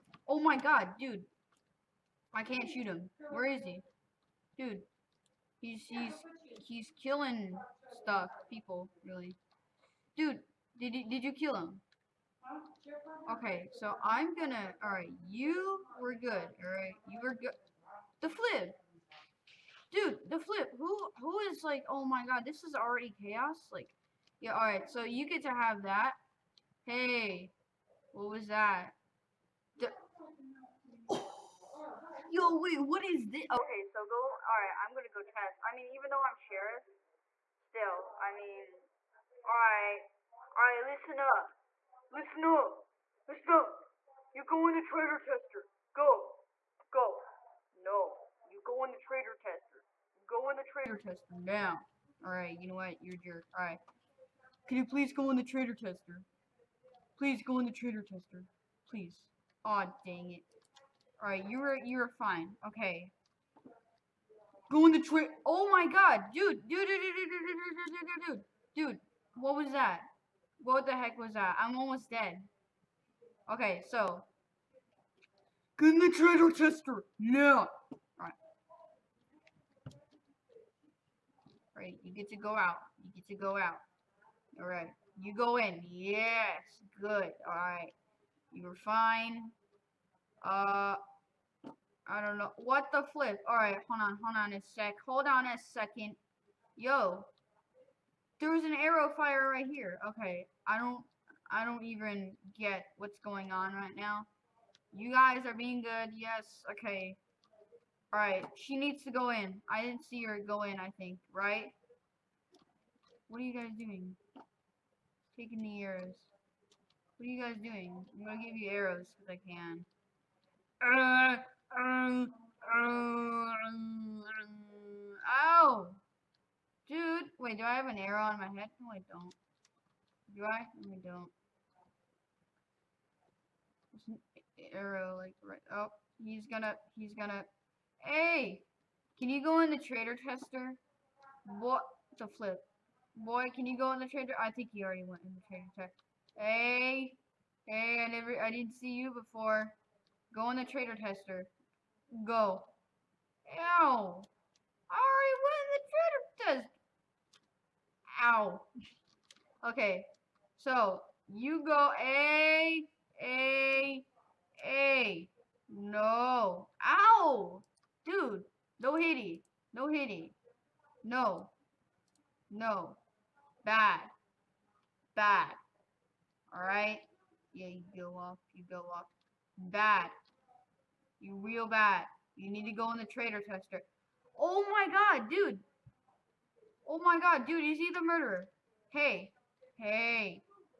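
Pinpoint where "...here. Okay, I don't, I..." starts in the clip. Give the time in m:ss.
1:39.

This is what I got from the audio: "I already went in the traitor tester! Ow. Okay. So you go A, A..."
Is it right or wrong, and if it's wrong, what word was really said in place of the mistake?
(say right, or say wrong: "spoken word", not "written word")
right.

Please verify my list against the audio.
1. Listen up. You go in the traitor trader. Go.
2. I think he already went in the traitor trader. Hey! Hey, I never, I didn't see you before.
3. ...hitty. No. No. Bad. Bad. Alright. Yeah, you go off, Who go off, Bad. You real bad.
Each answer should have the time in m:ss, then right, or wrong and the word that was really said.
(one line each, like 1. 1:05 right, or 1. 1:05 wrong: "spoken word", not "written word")
1. 0:43 wrong: "tester", not "trader"
2. 2:24 wrong: "tester", not "trader"
3. 2:49 wrong: "You", not "Who".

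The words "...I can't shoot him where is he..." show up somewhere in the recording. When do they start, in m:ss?
0:02.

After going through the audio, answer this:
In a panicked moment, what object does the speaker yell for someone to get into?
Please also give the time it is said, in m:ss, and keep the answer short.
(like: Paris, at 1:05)
Treasure chest, at 1:16.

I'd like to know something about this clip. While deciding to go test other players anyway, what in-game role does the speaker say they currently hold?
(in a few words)
Sheriff.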